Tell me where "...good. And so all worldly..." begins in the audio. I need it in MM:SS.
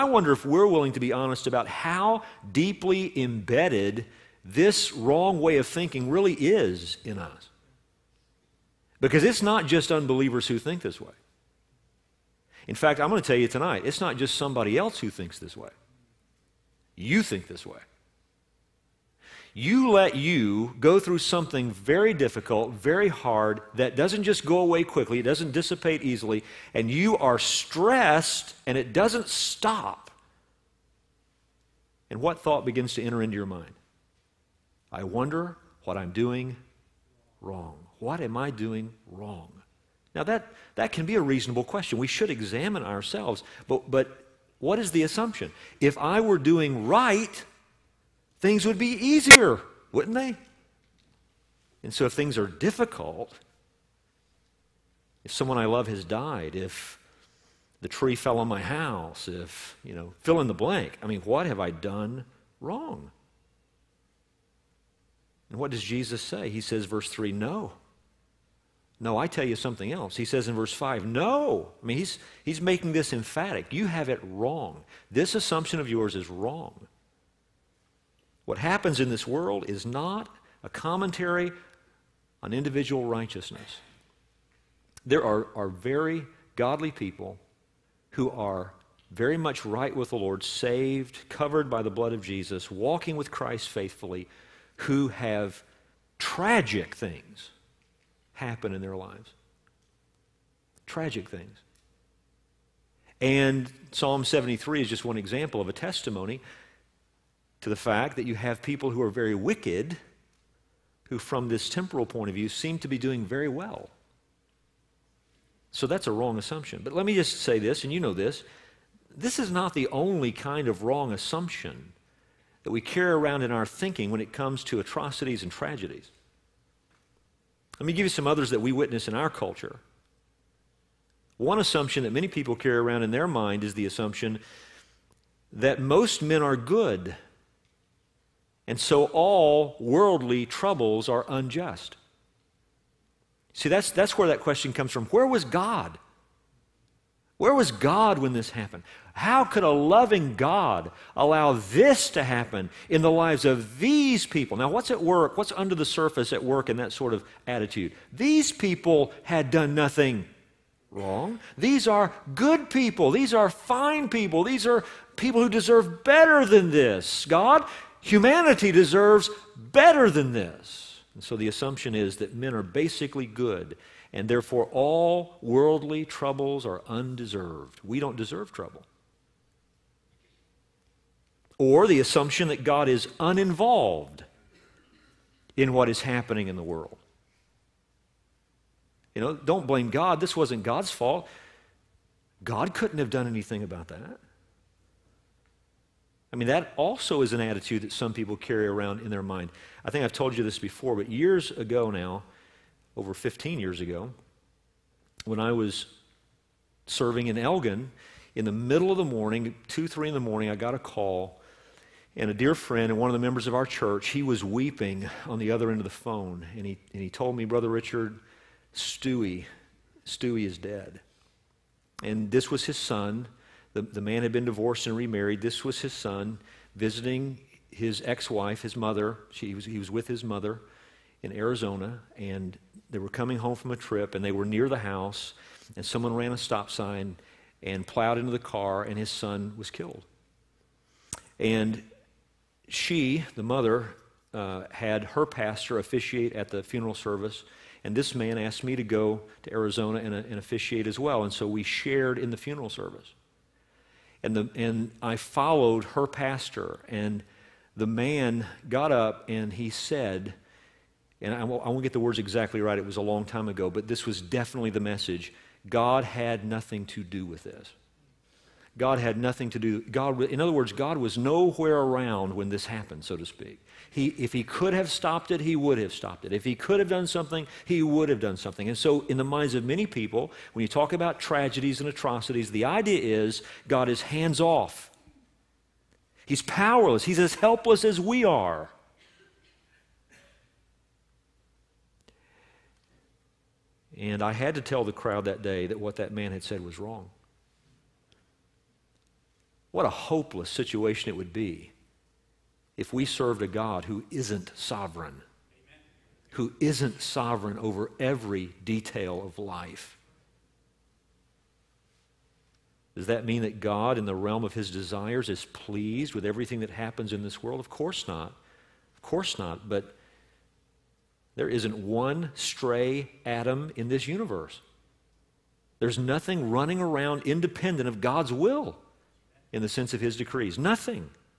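02:16.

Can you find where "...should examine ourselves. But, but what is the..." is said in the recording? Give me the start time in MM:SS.
00:42.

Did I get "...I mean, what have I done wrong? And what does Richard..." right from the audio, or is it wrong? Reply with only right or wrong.
wrong.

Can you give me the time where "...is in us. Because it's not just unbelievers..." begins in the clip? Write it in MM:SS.
00:06.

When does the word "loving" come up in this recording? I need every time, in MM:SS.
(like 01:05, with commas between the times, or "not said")
02:29.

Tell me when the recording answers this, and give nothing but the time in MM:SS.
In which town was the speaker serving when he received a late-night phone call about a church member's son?
03:27.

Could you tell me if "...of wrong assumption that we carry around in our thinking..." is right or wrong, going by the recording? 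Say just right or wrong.
right.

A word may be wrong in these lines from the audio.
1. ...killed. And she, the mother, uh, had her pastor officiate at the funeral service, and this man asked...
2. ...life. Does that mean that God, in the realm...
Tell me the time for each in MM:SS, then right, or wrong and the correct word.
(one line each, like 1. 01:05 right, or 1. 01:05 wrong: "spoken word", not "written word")
1. 03:59 right
2. 05:09 right.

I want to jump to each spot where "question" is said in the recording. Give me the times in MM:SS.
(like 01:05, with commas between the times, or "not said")
00:41, 02:24.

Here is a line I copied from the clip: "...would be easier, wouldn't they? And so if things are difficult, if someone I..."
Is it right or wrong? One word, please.
right.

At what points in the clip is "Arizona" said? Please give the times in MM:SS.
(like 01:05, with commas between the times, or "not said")
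03:51, 04:09.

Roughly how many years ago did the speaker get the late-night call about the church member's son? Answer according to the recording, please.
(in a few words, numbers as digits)
over 15 years.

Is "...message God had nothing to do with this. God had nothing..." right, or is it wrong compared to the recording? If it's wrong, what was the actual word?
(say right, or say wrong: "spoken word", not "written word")
right.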